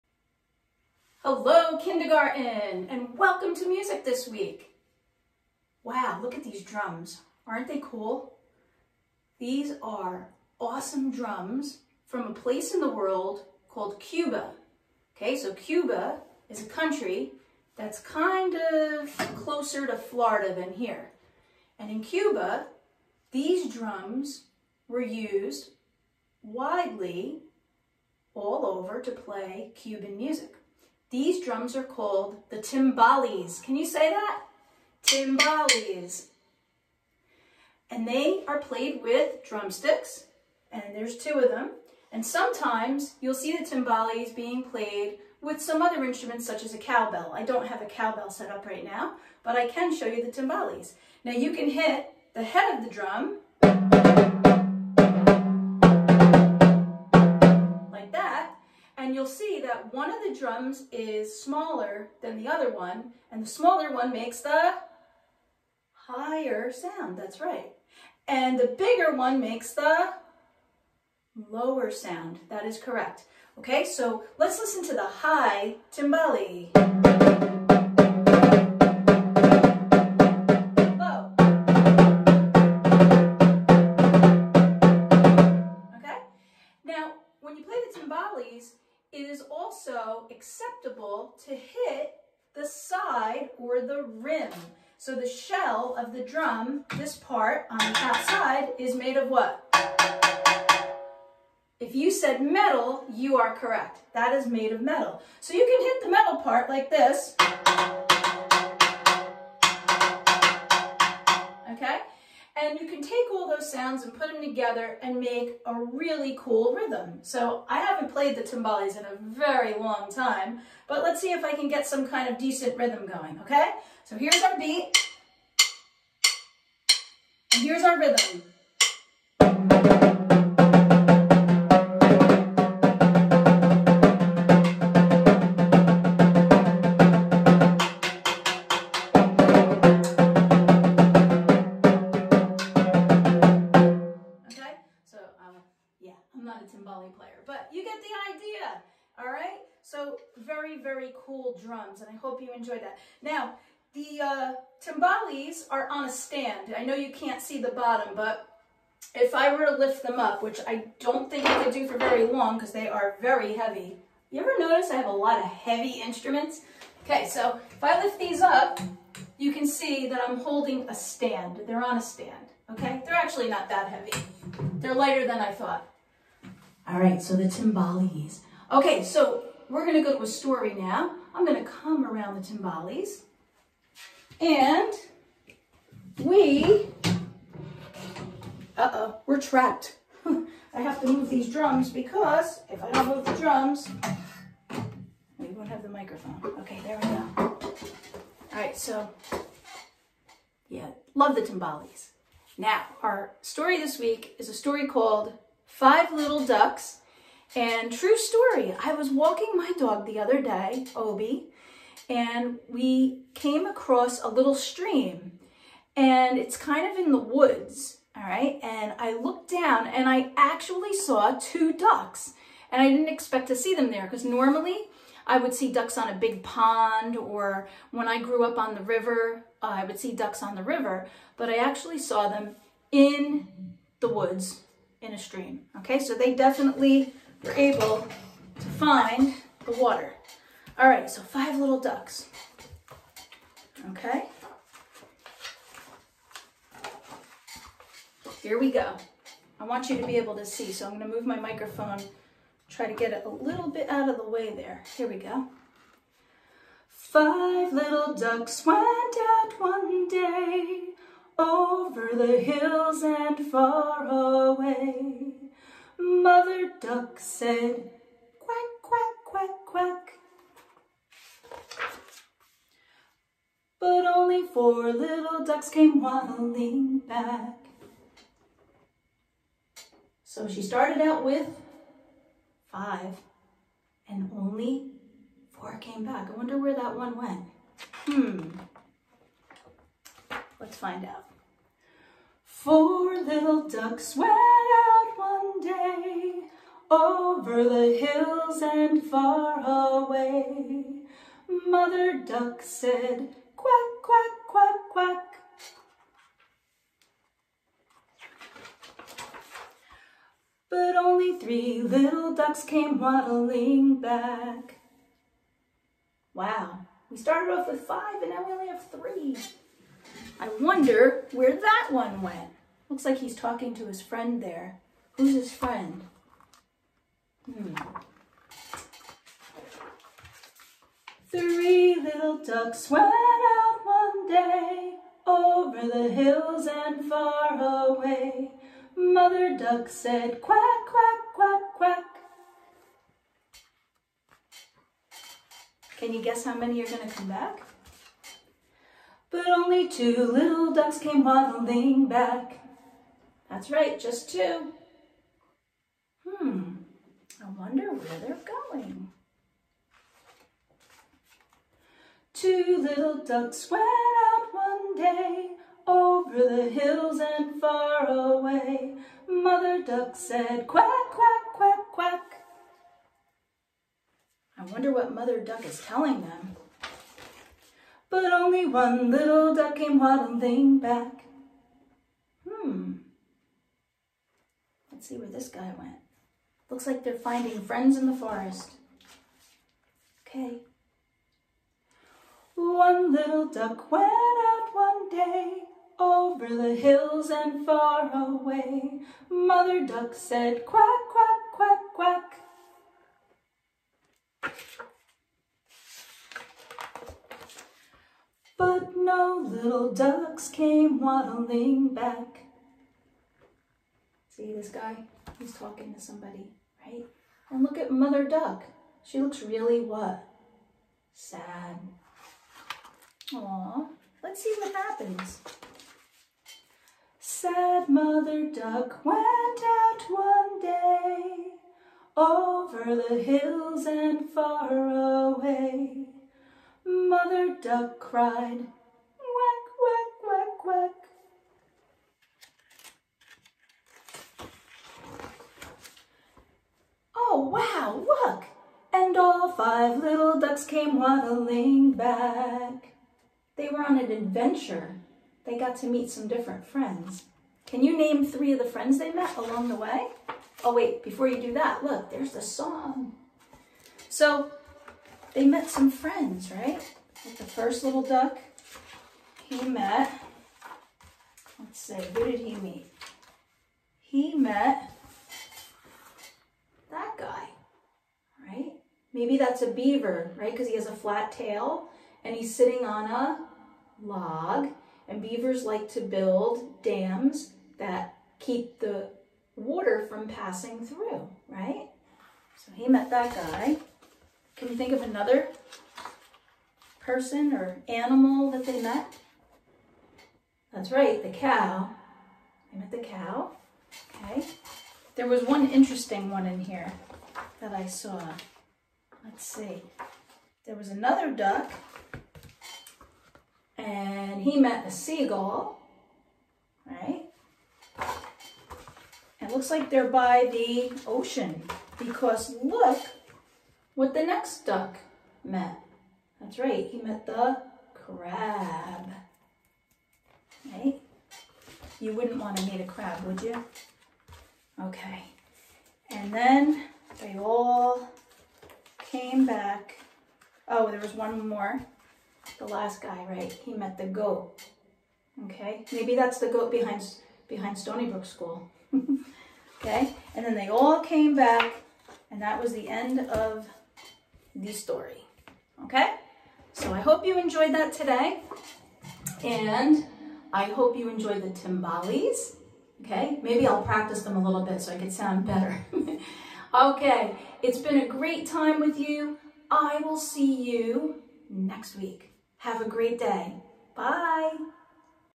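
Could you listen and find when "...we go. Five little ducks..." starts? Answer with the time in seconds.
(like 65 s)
255 s.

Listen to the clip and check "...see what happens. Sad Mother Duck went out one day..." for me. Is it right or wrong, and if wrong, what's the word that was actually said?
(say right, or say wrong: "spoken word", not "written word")
right.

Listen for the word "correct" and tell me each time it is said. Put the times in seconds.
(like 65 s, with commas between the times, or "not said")
72 s, 103 s.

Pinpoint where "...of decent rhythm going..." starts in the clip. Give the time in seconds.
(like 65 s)
122 s.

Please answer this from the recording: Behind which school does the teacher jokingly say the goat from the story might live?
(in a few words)
Stony Brook School.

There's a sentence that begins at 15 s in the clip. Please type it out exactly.
Okay, so Cuba is a country that's kind of closer to Florida than here.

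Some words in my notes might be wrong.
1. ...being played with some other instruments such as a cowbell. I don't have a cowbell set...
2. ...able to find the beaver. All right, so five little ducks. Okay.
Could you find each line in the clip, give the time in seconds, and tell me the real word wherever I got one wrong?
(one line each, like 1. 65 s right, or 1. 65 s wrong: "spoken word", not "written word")
1. 44 s right
2. 237 s wrong: "water", not "beaver".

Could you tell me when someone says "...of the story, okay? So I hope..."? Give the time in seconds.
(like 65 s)
553 s.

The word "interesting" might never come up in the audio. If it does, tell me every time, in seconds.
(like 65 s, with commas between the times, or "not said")
505 s.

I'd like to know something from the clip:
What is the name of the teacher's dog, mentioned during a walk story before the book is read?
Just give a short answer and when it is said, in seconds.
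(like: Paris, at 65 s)
Obi, at 210 s.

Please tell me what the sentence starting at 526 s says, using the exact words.
That's right, he met the crab.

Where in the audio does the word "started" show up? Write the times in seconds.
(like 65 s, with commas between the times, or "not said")
280 s, 317 s.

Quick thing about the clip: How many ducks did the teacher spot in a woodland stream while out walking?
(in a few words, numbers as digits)
2.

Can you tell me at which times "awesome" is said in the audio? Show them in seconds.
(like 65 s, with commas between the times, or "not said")
10 s.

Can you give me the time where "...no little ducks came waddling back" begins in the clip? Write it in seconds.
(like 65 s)
408 s.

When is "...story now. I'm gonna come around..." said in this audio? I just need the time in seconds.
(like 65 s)
180 s.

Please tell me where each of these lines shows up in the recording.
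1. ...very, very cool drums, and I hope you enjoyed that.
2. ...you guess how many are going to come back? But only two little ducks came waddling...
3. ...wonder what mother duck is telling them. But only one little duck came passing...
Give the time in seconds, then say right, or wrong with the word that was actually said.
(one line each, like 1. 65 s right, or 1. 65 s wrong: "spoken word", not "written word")
1. 150 s right
2. 346 s right
3. 374 s wrong: "waddling", not "passing".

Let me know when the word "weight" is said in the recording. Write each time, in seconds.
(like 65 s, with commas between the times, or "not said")
not said.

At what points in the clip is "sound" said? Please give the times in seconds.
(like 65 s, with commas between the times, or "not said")
66 s, 71 s, 113 s, 565 s.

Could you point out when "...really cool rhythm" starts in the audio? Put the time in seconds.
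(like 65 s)
115 s.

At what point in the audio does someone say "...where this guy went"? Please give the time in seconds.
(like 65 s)
385 s.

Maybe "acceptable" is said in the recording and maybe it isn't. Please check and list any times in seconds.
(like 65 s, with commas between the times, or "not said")
90 s.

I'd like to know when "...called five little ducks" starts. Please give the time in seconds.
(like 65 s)
204 s.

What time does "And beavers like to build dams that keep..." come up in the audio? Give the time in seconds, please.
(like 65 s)
485 s.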